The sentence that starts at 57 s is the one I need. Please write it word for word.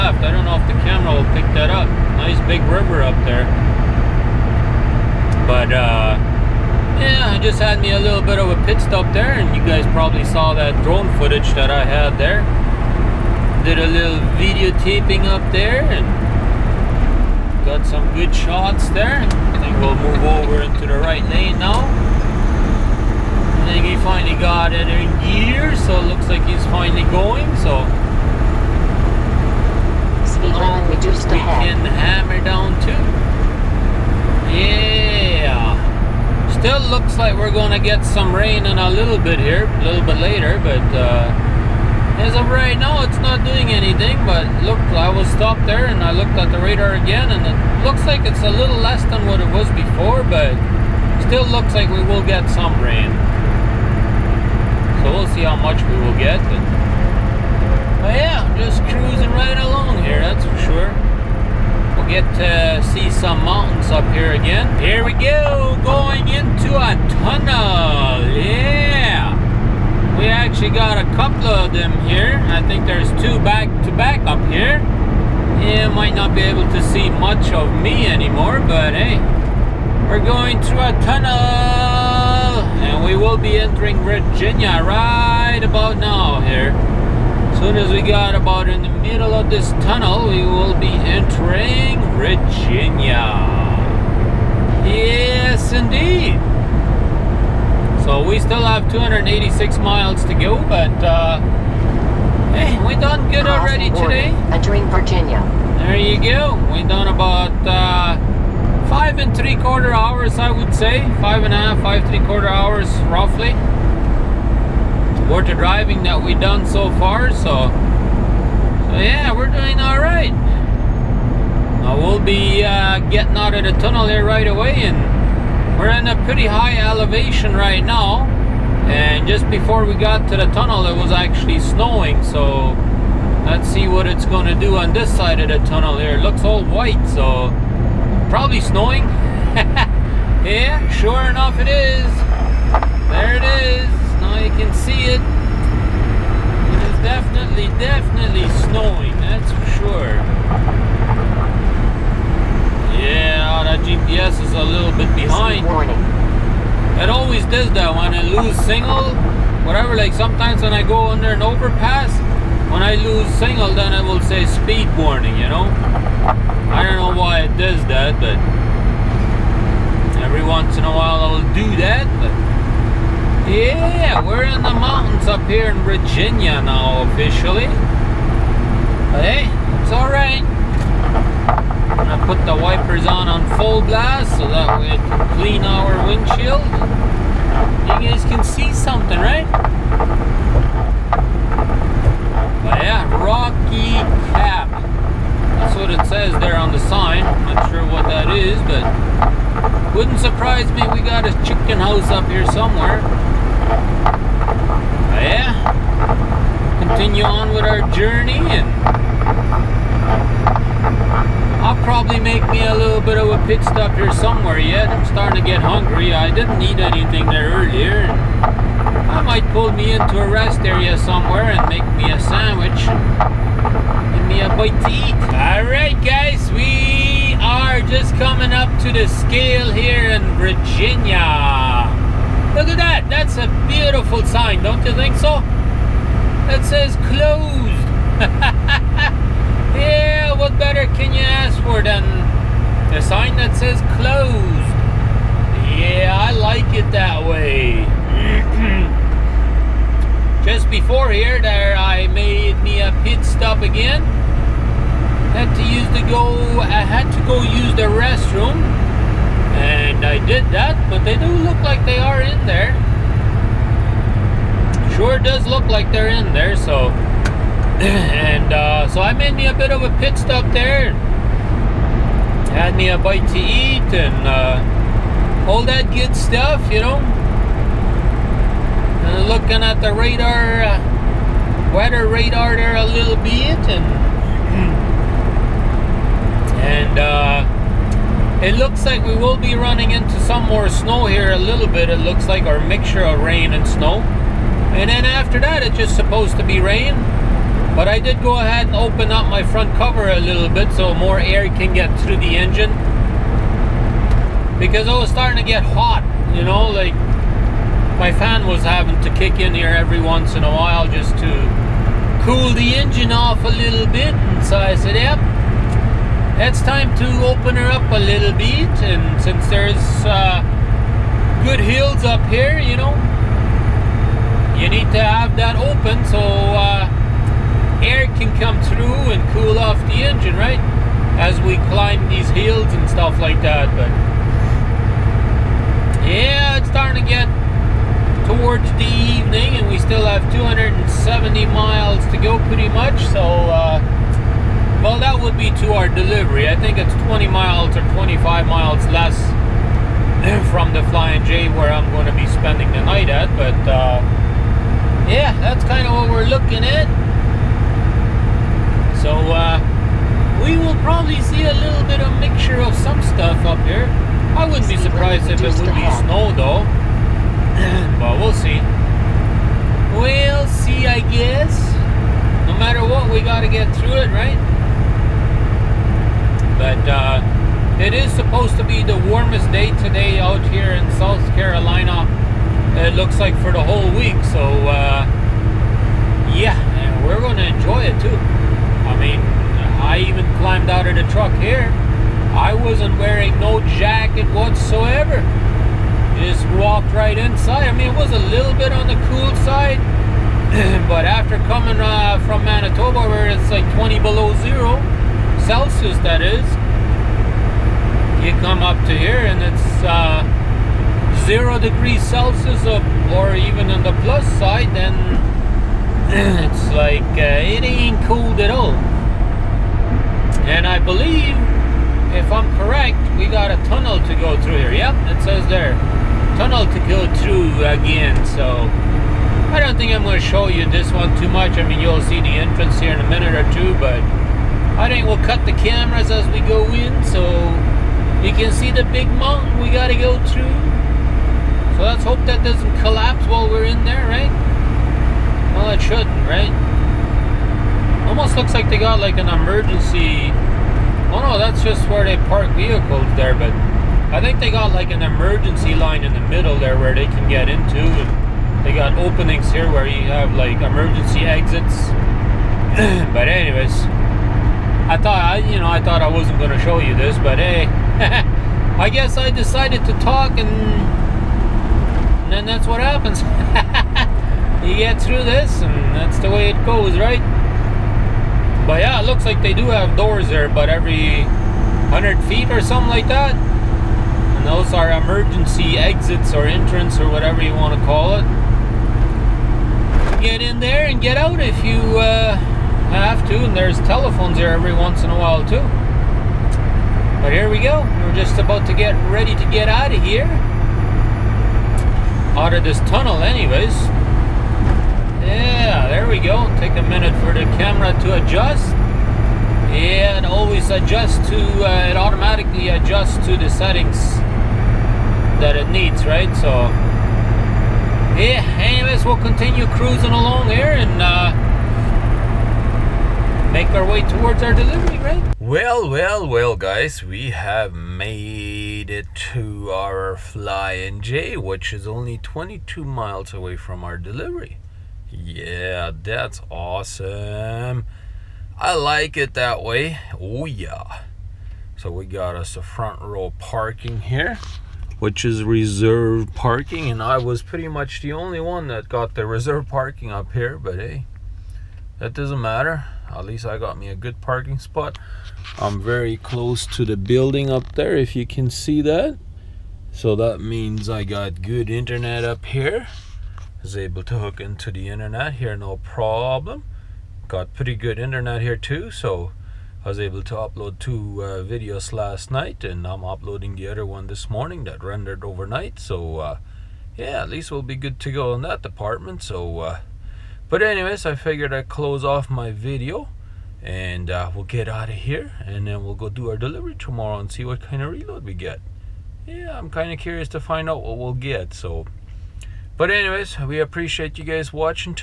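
Well, yeah, just cruising right along here, that's for sure.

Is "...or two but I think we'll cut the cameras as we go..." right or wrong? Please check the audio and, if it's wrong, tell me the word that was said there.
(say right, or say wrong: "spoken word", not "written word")
right.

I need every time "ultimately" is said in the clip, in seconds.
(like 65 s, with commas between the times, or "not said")
not said.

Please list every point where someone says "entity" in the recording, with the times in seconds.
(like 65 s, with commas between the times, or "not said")
not said.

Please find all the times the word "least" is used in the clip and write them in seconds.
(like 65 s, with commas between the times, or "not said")
553 s, 577 s.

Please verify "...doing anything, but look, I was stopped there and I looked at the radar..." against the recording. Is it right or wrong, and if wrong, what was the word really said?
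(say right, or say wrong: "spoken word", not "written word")
right.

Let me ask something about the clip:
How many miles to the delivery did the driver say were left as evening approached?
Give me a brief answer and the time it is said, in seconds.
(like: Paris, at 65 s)
270, at 340 s.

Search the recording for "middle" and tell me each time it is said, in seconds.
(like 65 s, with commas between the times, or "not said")
88 s, 456 s.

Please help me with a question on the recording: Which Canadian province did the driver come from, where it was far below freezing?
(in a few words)
Manitoba.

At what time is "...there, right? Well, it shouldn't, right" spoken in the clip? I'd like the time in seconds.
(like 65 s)
443 s.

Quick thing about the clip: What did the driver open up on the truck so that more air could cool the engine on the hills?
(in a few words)
Front cover.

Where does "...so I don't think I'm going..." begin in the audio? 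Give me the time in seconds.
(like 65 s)
428 s.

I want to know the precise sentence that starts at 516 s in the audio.
So, yeah, anyways, we'll continue cruising along here and uh, make our way towards our delivery, right?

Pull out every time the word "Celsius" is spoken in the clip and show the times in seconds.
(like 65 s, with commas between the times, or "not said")
405 s, 412 s.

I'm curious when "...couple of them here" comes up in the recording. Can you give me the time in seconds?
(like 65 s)
71 s.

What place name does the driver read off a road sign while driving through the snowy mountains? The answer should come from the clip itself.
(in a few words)
Rocky Gap.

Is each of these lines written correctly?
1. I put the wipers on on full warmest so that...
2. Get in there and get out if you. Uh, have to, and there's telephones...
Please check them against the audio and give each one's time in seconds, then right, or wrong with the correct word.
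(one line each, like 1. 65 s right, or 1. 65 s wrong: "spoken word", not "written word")
1. 182 s wrong: "blast", not "warmest"
2. 490 s right.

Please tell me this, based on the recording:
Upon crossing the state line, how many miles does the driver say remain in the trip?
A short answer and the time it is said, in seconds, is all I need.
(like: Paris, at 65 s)
286, at 98 s.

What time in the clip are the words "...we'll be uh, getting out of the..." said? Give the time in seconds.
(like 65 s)
121 s.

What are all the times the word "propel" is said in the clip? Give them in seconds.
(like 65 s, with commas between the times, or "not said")
not said.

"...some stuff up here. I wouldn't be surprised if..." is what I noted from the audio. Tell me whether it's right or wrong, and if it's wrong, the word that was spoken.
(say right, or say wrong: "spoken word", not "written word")
right.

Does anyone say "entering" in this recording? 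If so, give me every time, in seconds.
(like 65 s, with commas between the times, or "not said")
83 s, 90 s, 104 s.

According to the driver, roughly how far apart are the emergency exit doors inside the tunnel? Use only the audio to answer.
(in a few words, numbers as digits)
100 feet.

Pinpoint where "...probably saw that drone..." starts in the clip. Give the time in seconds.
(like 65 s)
9 s.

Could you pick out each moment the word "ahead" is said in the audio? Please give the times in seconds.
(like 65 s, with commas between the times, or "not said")
298 s.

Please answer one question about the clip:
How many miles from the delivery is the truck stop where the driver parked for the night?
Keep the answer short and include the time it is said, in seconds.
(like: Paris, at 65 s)
22, at 532 s.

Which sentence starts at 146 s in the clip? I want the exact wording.
It is definitely, definitely snowing, that's for sure.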